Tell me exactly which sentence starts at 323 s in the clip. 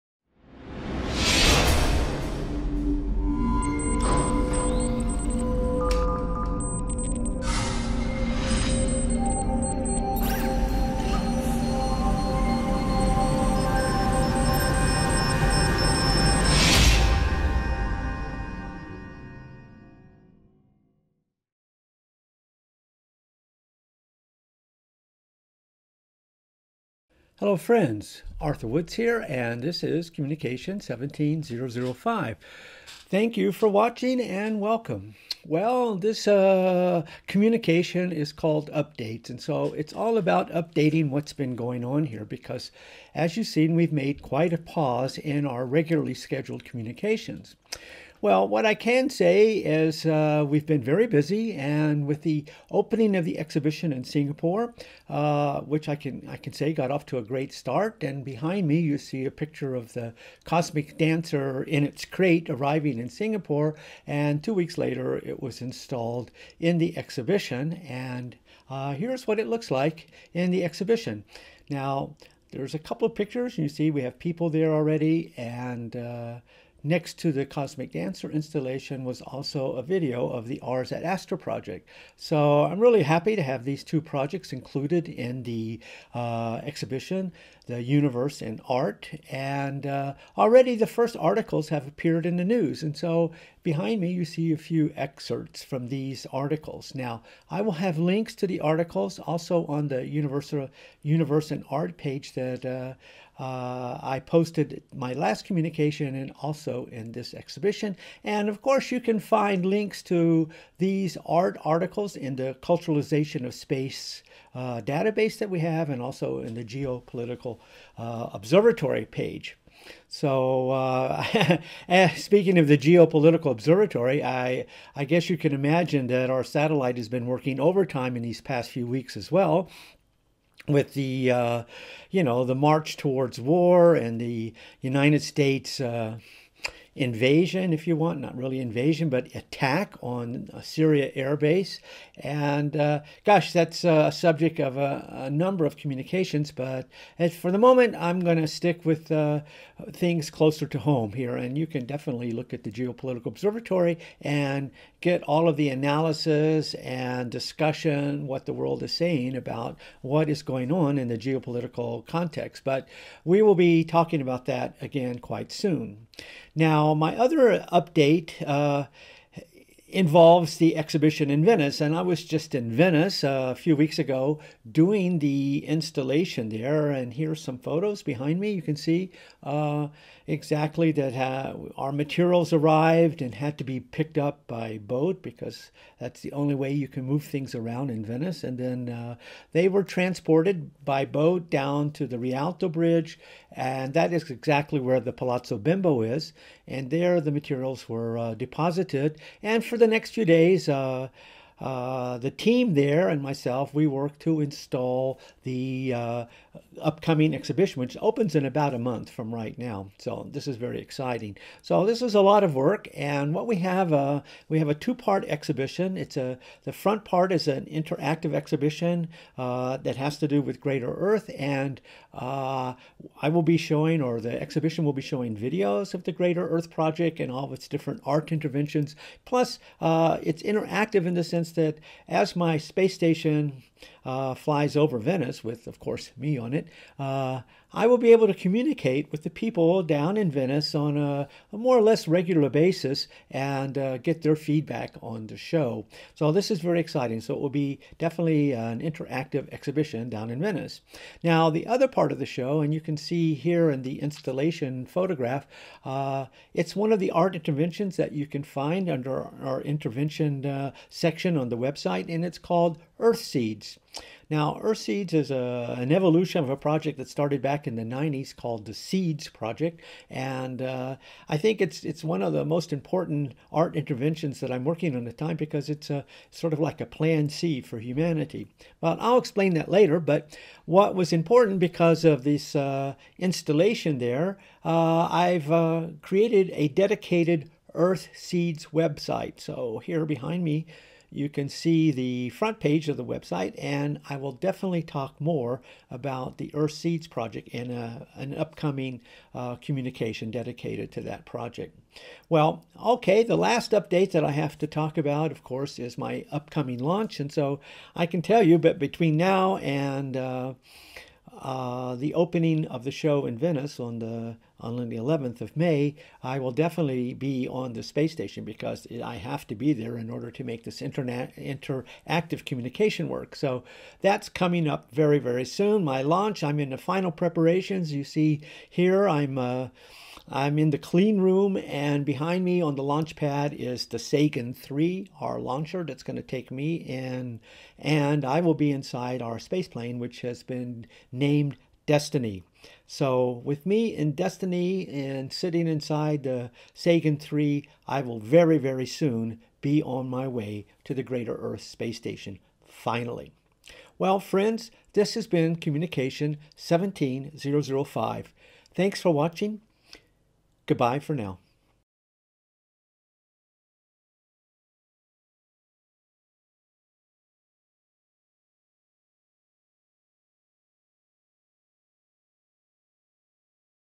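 So that's coming up very very soon.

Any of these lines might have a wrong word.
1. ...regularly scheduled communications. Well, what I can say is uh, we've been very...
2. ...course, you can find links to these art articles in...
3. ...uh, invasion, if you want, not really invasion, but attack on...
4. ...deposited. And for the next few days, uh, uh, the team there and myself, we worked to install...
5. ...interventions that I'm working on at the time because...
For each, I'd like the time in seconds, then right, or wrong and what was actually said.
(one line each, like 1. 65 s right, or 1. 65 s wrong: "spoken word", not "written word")
1. 45 s right
2. 108 s right
3. 135 s right
4. 198 s right
5. 273 s right.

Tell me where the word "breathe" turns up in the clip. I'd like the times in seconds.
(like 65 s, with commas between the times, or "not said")
not said.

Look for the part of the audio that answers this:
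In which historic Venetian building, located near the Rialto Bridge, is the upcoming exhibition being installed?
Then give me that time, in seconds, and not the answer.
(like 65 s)
195 s.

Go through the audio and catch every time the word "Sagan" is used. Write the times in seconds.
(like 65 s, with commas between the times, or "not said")
333 s, 346 s.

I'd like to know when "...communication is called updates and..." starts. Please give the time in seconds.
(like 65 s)
37 s.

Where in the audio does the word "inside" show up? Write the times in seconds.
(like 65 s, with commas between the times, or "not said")
338 s, 345 s.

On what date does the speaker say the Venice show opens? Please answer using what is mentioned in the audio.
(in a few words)
11 May.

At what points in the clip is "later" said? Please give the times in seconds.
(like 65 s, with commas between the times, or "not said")
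64 s, 279 s.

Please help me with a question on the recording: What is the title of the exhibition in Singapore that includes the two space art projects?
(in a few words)
The Universe in Art.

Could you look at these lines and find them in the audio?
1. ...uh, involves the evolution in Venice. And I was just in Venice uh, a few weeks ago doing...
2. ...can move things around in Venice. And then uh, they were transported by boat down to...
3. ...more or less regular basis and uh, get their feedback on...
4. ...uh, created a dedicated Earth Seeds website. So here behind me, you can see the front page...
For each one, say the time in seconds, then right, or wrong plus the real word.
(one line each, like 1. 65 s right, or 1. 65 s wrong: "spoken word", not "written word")
1. 168 s wrong: "exhibition", not "evolution"
2. 186 s right
3. 241 s right
4. 285 s right.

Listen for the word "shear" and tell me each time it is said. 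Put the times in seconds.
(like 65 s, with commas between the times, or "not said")
not said.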